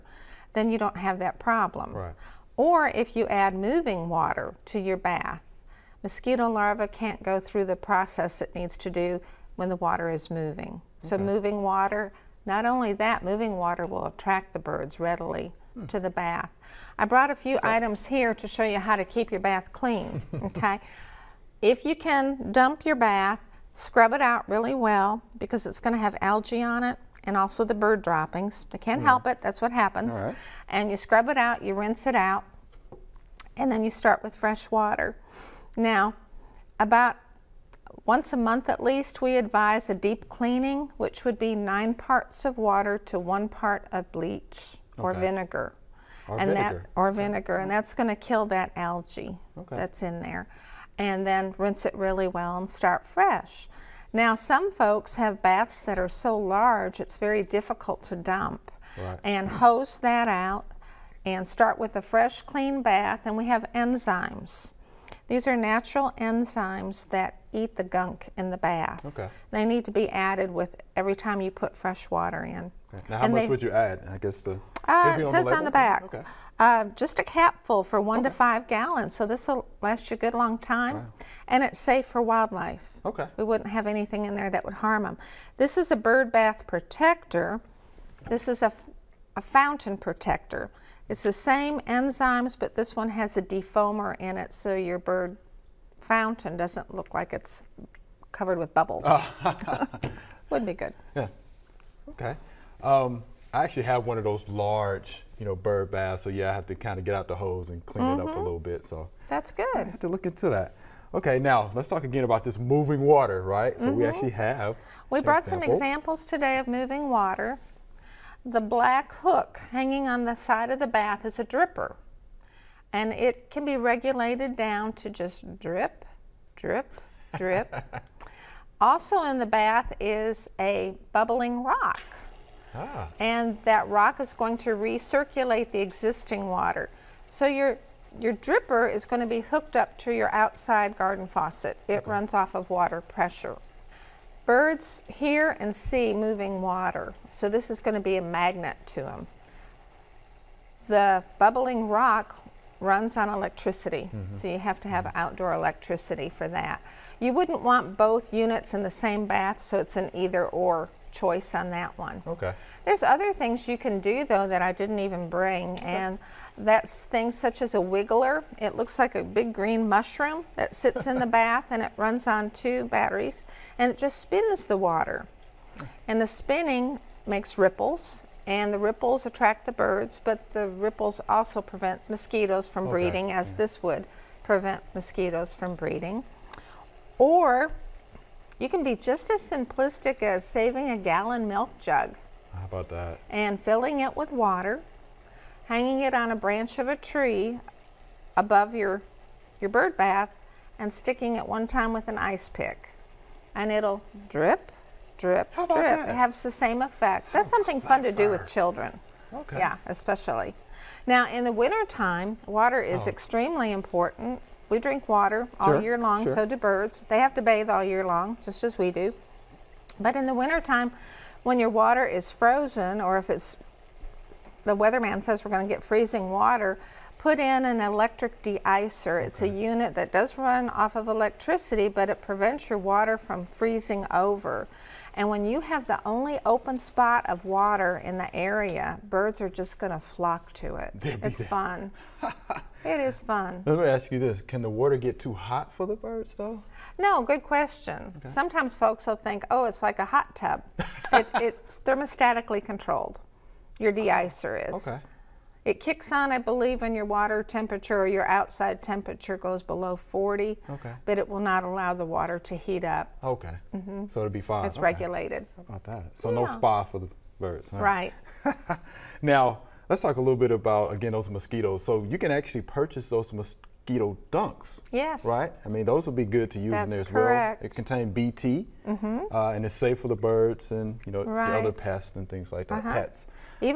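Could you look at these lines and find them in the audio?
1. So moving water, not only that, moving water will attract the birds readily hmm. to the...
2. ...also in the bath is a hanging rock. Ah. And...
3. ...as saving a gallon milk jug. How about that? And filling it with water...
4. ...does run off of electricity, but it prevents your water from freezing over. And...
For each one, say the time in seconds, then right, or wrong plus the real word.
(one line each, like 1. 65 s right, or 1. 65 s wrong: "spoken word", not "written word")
1. 11 s right
2. 128 s wrong: "bubbling", not "hanging"
3. 190 s right
4. 230 s right.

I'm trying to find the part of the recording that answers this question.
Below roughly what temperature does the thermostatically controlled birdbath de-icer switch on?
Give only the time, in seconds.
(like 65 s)
259 s.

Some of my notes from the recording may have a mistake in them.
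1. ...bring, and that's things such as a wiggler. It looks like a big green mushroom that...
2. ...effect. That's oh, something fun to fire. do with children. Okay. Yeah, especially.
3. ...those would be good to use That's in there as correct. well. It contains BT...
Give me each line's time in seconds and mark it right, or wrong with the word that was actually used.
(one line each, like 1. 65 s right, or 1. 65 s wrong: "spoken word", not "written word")
1. 165 s right
2. 206 s right
3. 275 s right.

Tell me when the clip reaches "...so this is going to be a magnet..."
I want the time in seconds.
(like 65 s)
147 s.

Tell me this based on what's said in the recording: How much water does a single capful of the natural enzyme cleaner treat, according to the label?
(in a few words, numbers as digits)
1 to 5 gallons.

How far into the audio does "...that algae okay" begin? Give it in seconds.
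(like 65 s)
48 s.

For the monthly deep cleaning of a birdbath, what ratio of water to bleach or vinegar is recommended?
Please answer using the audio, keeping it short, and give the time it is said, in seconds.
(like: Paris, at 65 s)
9 to 1, at 41 s.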